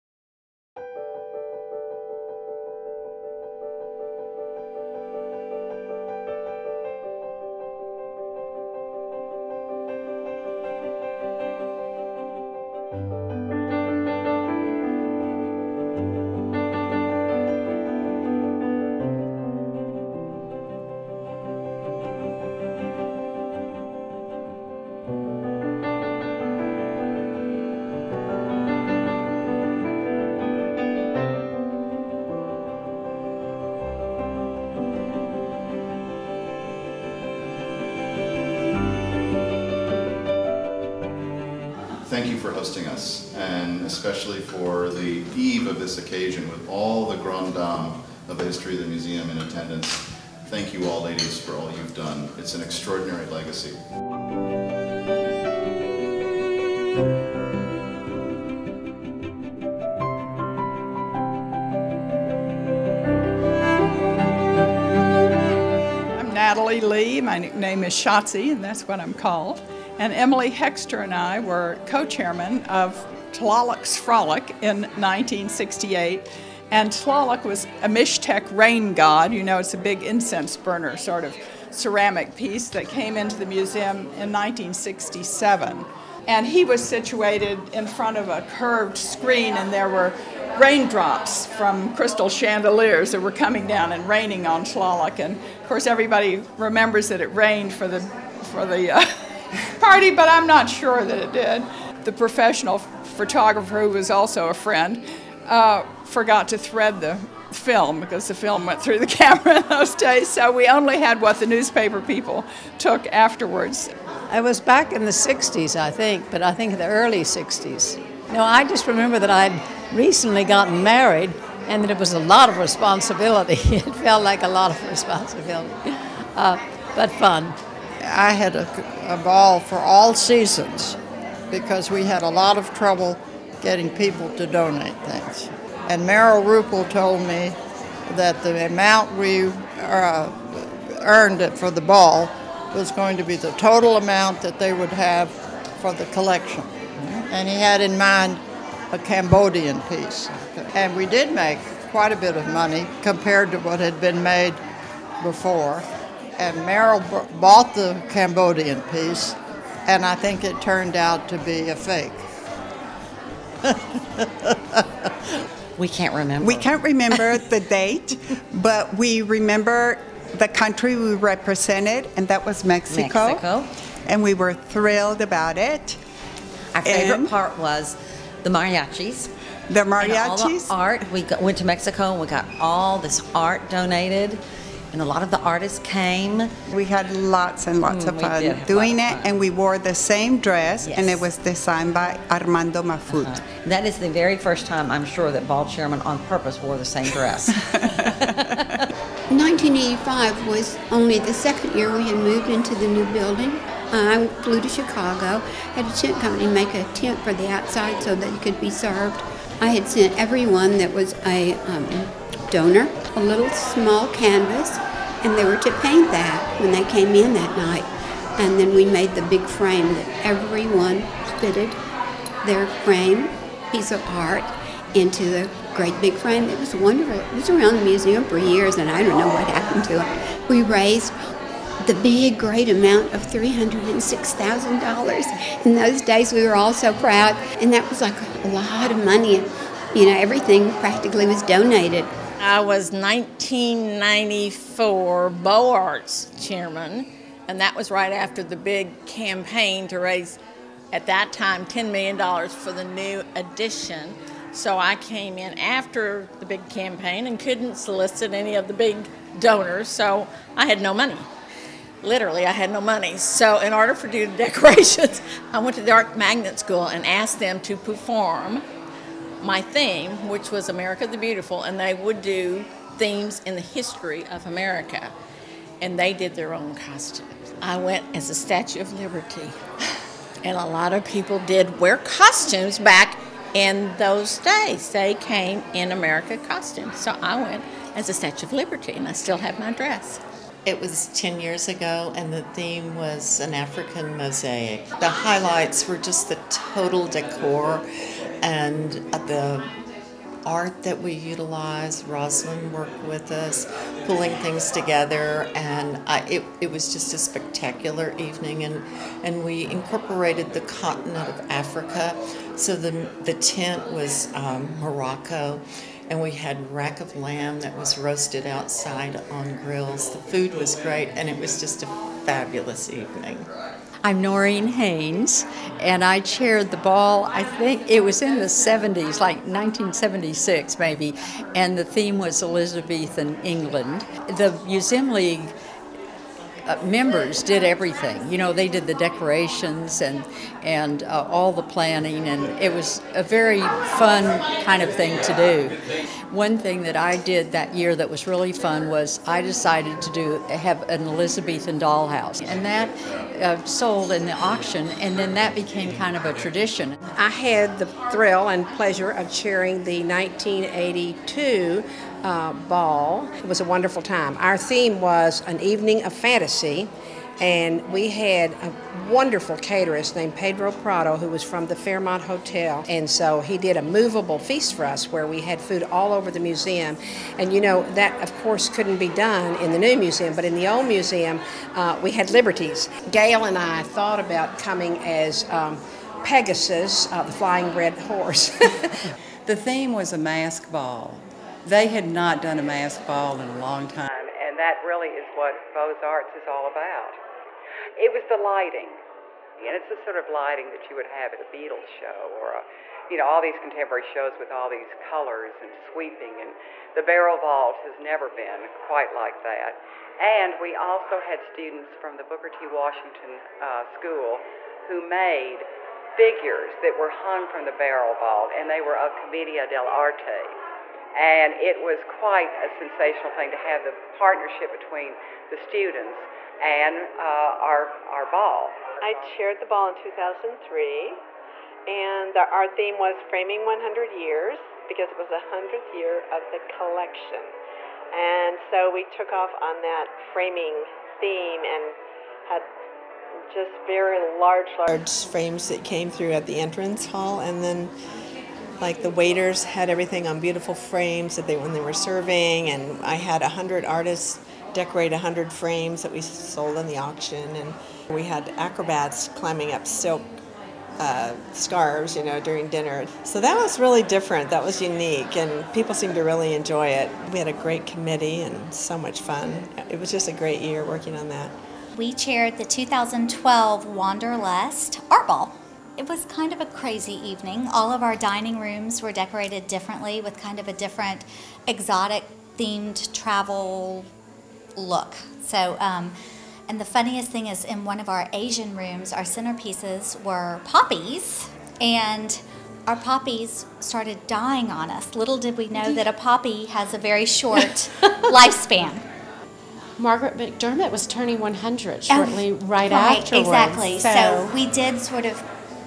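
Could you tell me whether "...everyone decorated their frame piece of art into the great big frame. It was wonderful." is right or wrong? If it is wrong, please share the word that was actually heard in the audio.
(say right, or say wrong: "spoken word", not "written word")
wrong: "fitted", not "decorated".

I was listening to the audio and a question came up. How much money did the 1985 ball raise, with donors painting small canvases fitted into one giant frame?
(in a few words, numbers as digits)
$306,000.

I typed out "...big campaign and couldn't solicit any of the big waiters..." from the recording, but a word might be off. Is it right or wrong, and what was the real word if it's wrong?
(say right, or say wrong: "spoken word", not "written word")
wrong: "donors", not "waiters".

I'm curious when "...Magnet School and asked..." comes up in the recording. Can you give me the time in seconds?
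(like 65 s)
266 s.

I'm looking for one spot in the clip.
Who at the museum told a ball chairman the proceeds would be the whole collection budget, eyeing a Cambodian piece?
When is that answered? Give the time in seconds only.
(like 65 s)
136 s.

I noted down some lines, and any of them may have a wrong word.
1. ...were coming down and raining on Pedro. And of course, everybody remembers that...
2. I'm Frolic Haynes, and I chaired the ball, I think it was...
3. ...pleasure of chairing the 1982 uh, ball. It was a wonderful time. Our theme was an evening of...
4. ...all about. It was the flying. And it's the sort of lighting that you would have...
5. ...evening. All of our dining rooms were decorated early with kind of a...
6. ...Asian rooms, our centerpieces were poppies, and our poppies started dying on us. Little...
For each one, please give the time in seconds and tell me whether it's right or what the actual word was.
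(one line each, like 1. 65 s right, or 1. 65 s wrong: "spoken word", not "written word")
1. 93 s wrong: "Tlaloc", not "Pedro"
2. 324 s wrong: "Noreen", not "Frolic"
3. 358 s right
4. 396 s wrong: "lighting", not "flying"
5. 477 s wrong: "differently", not "early"
6. 488 s right.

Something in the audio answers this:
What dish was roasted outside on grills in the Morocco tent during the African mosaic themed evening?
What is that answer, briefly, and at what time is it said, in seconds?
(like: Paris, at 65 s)
rack of lamb, at 316 s.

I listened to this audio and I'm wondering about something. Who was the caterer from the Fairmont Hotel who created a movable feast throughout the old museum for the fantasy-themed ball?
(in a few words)
Pedro Prado.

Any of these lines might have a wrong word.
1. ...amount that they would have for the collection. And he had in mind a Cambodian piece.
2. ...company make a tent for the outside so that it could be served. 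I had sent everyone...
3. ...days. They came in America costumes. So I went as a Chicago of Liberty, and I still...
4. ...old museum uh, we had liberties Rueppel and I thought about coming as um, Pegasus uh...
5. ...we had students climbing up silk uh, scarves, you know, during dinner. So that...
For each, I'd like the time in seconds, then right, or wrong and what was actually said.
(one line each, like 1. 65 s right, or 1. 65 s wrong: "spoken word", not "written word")
1. 143 s right
2. 206 s right
3. 284 s wrong: "Statue", not "Chicago"
4. 380 s wrong: "Gail", not "Rueppel"
5. 458 s wrong: "acrobats", not "students".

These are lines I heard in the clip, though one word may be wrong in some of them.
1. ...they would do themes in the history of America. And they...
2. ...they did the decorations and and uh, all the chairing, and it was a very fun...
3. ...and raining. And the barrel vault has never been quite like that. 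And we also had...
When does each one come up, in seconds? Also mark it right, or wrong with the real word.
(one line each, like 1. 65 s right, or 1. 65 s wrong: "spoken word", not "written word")
1. 271 s right
2. 338 s wrong: "planning", not "chairing"
3. 405 s wrong: "sweeping", not "raining".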